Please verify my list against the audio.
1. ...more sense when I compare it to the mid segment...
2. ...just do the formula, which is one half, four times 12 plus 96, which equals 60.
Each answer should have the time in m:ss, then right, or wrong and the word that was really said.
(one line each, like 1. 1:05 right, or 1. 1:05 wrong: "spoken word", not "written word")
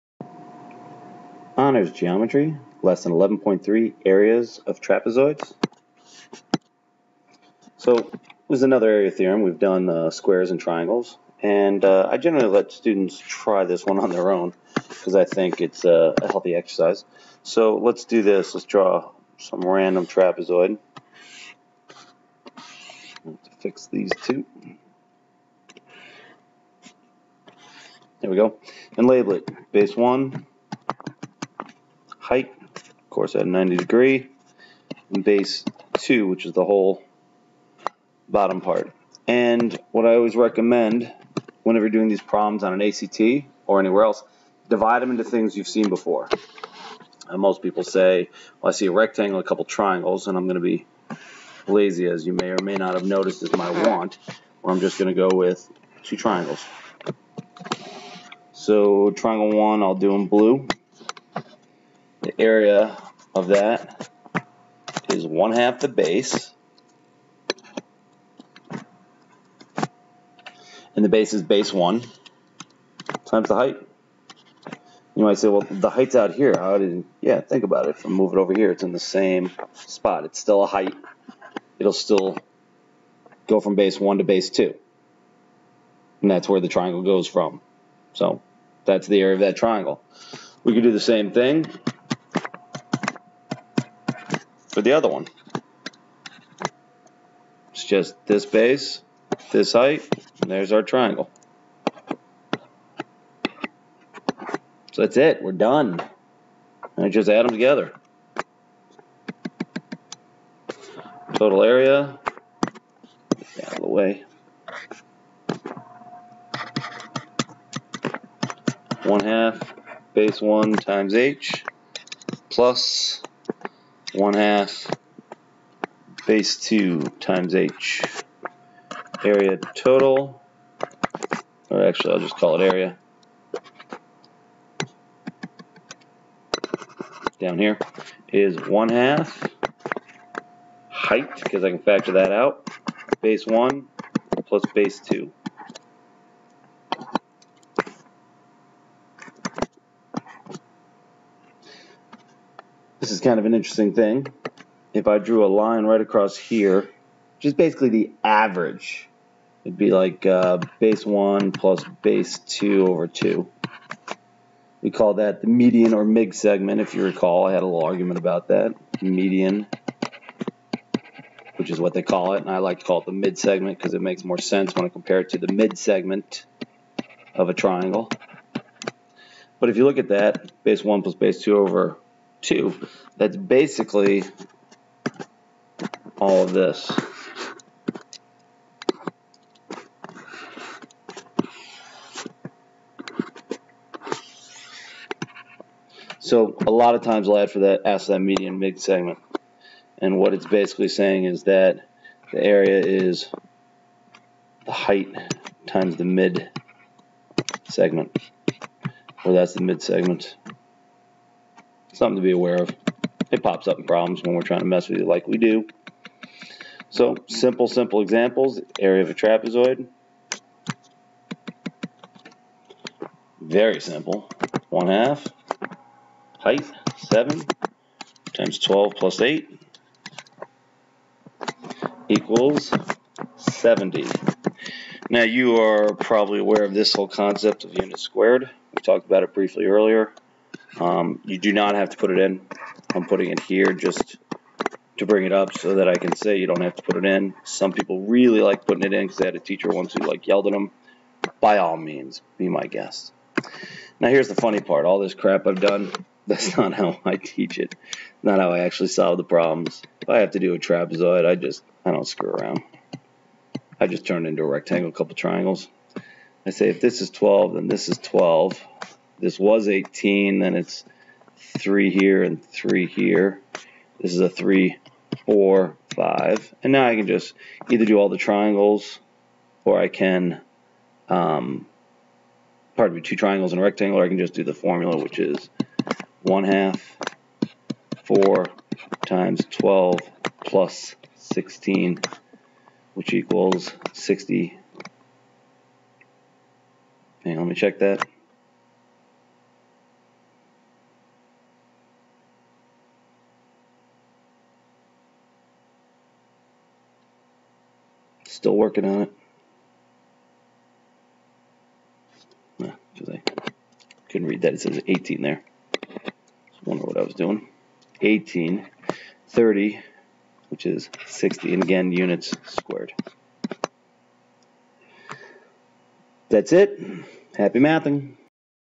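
1. 2:54 right
2. 4:44 wrong: "16", not "96".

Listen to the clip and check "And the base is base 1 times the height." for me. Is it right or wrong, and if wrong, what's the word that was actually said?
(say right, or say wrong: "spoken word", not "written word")
right.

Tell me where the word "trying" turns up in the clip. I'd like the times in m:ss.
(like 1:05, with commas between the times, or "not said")
3:34.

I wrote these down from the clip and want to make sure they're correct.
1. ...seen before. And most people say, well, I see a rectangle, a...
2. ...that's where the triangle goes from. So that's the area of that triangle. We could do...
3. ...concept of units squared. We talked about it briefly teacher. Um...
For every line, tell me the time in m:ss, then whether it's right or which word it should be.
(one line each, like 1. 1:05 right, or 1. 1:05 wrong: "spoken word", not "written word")
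1. 0:45 right
2. 1:26 right
3. 3:57 wrong: "earlier", not "teacher".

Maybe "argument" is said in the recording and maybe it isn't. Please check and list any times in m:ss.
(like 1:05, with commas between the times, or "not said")
2:47.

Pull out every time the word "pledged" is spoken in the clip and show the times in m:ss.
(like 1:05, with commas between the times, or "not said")
not said.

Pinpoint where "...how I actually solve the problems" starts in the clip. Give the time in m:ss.
4:18.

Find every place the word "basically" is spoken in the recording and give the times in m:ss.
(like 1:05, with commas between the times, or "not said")
2:37, 3:03, 3:20.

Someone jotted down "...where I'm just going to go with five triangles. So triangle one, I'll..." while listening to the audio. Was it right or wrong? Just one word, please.
wrong.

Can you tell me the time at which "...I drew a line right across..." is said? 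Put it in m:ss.
2:35.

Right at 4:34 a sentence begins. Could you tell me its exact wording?
This is a three, four, five.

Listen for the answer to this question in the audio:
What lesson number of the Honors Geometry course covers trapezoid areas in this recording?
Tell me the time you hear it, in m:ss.
0:02.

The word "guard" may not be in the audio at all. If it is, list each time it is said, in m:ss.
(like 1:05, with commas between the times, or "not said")
not said.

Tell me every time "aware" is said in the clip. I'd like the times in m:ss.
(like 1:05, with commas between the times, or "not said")
3:32, 3:56.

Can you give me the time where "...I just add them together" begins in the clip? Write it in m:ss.
1:47.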